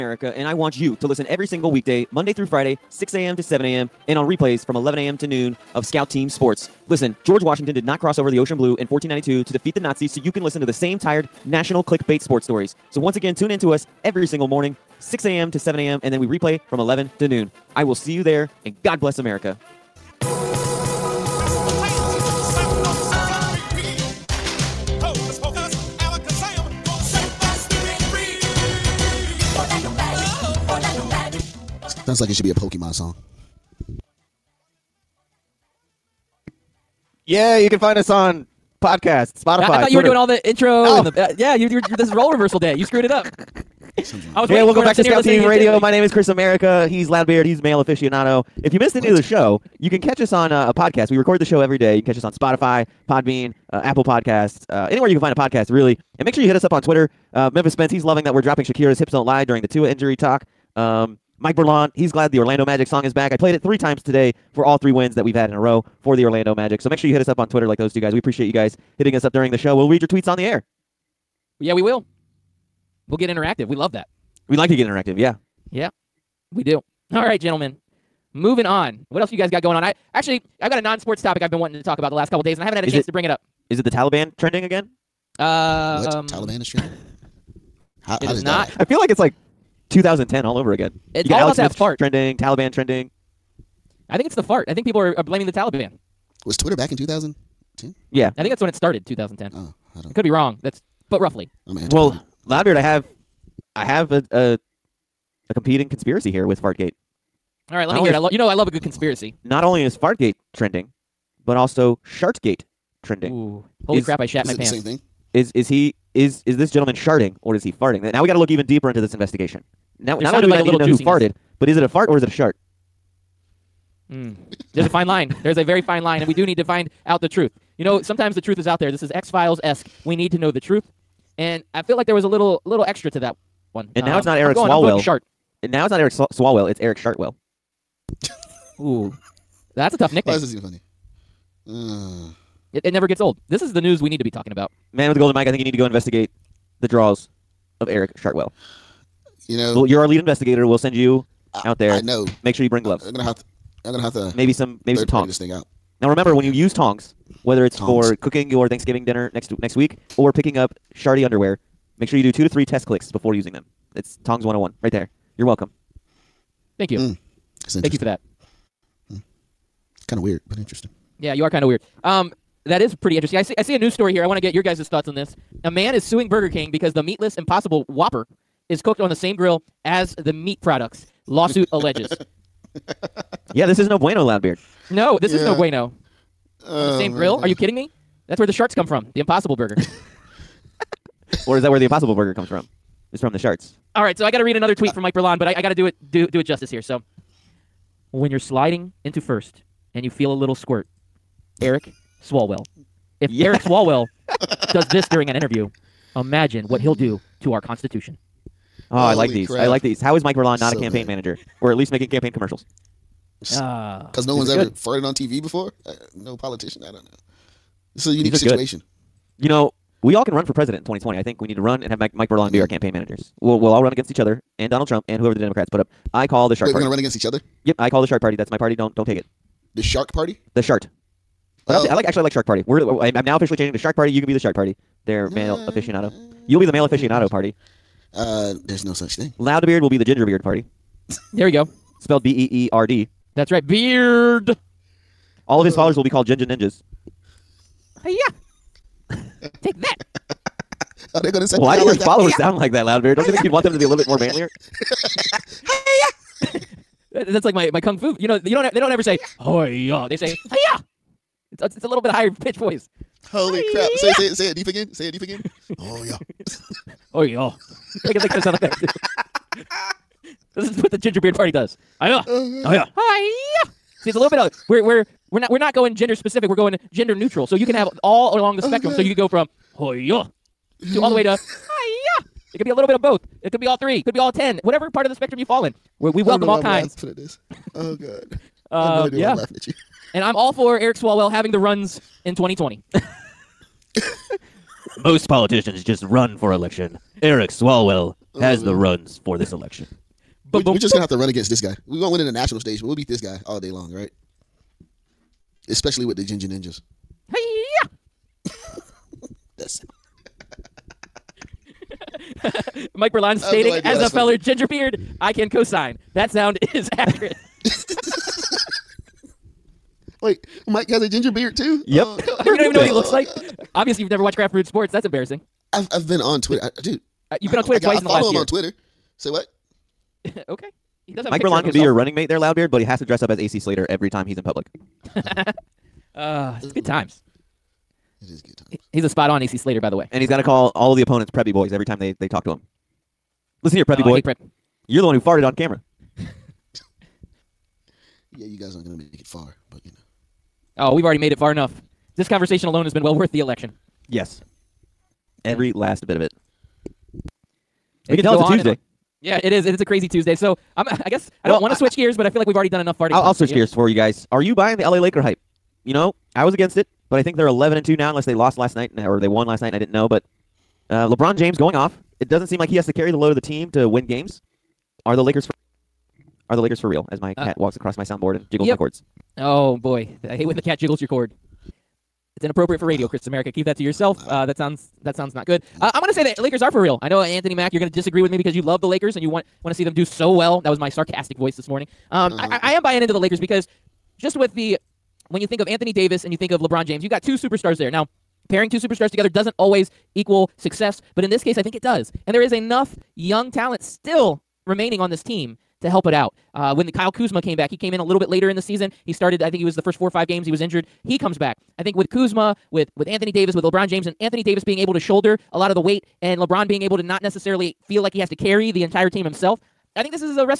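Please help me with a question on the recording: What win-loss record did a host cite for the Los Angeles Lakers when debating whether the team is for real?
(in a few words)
11 and 2.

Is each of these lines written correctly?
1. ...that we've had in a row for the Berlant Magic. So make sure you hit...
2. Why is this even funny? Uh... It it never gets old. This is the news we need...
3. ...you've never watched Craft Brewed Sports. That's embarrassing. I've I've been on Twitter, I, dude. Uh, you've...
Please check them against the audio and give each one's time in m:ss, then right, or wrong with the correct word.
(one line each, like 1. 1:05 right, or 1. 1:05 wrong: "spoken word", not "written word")
1. 1:05 wrong: "Orlando", not "Berlant"
2. 2:20 right
3. 5:24 right.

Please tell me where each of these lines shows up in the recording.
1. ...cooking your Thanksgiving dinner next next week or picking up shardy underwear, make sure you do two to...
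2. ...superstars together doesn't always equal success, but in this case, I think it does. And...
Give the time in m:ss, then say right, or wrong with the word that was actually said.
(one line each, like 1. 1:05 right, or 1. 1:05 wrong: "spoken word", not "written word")
1. 2:38 right
2. 6:38 right.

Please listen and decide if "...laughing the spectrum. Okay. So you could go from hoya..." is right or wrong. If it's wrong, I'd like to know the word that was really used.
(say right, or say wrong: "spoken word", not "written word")
wrong: "along", not "laughing".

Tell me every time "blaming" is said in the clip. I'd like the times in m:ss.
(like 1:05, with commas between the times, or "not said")
1:35.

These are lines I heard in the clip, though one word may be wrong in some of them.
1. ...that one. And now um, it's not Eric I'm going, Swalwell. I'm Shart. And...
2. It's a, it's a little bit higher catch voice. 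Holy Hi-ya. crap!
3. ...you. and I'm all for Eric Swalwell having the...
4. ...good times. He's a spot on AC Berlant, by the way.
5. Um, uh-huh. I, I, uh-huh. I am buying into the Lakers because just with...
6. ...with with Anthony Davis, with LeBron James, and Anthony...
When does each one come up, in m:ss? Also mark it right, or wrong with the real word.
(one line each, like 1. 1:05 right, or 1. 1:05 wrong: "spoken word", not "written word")
1. 2:13 right
2. 4:21 wrong: "pitch", not "catch"
3. 4:49 right
4. 5:38 wrong: "Slater", not "Berlant"
5. 6:32 right
6. 6:52 right.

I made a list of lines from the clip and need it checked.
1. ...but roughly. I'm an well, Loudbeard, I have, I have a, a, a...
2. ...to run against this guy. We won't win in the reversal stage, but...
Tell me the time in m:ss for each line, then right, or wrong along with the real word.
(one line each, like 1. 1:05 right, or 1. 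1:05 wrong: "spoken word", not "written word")
1. 1:41 right
2. 5:01 wrong: "national", not "reversal".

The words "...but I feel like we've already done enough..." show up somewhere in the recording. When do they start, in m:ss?
6:02.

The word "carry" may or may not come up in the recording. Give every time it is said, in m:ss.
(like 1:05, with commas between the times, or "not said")
6:12, 6:58.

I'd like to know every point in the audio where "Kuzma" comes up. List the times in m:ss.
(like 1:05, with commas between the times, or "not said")
6:47, 6:52.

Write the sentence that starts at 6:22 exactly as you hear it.
It's inappropriate for radio, Chris America.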